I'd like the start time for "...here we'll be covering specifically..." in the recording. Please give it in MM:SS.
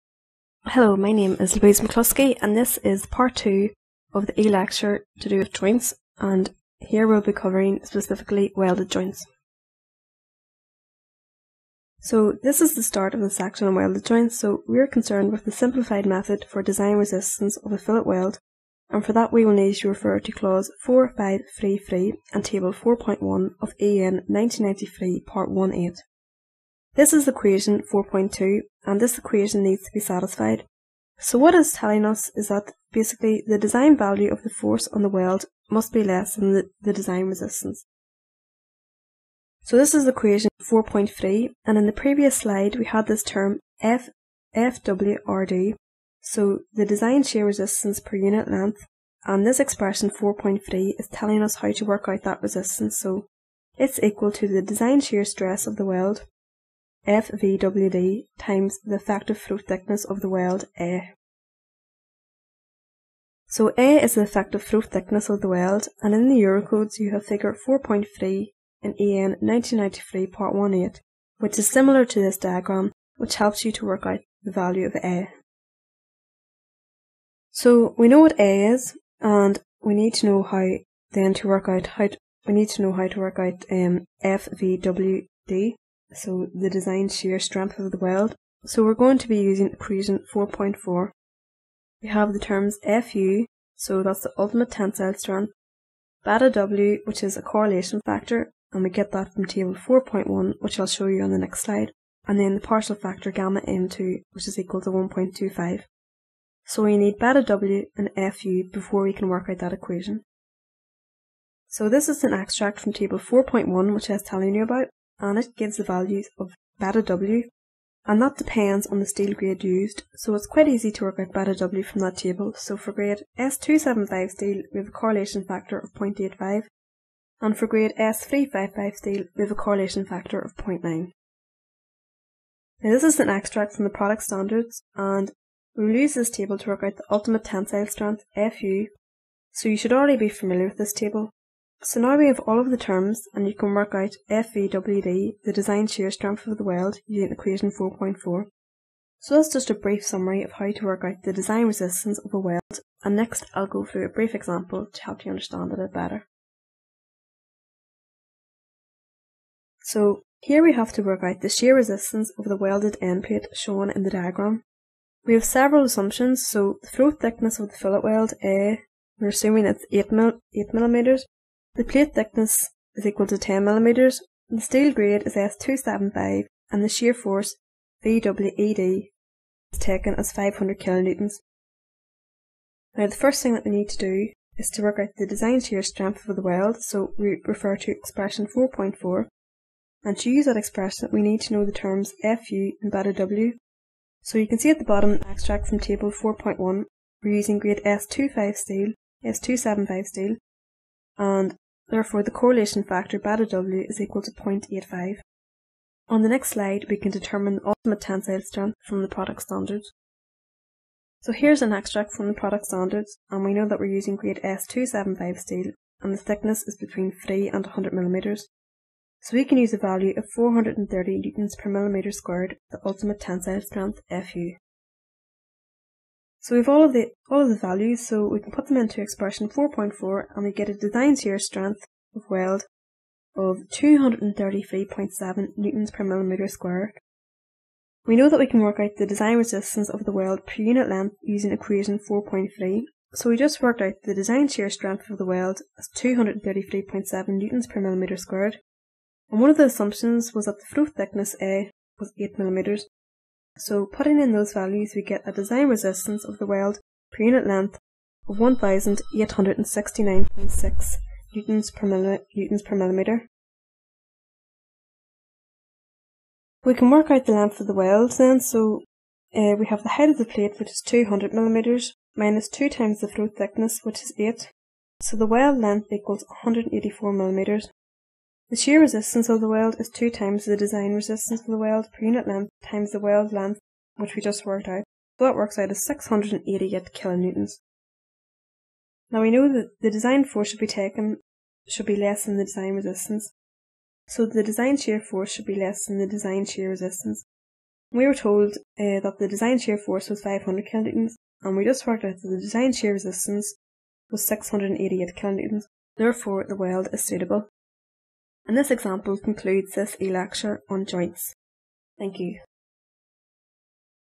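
00:06.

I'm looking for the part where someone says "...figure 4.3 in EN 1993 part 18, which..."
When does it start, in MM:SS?
01:07.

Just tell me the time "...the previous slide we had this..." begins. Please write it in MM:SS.
00:41.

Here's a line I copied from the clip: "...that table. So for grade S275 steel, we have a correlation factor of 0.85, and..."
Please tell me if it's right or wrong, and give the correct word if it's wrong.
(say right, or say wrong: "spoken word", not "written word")
right.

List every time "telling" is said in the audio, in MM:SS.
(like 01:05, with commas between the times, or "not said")
00:31, 00:51, 01:54.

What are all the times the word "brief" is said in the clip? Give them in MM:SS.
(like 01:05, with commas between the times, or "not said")
02:29, 02:34.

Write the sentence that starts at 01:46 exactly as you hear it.
So we need beta W and FU before we can work out that equation.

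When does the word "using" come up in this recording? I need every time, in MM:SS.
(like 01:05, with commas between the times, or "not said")
01:29, 02:27, 03:17, 03:33, 04:01.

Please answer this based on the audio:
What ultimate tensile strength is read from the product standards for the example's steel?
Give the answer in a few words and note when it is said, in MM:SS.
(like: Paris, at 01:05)
430 N/mm², at 03:40.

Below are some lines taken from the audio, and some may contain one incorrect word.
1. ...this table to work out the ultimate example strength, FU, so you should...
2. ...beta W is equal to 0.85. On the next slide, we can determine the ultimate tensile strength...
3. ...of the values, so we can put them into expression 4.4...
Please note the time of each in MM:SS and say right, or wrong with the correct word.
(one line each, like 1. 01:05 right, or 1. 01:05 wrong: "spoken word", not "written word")
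1. 02:16 wrong: "tensile", not "example"
2. 03:23 right
3. 03:47 right.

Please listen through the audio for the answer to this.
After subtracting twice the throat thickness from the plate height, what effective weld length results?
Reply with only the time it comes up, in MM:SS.
04:36.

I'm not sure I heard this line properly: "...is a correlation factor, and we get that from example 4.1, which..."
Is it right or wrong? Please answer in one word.
wrong.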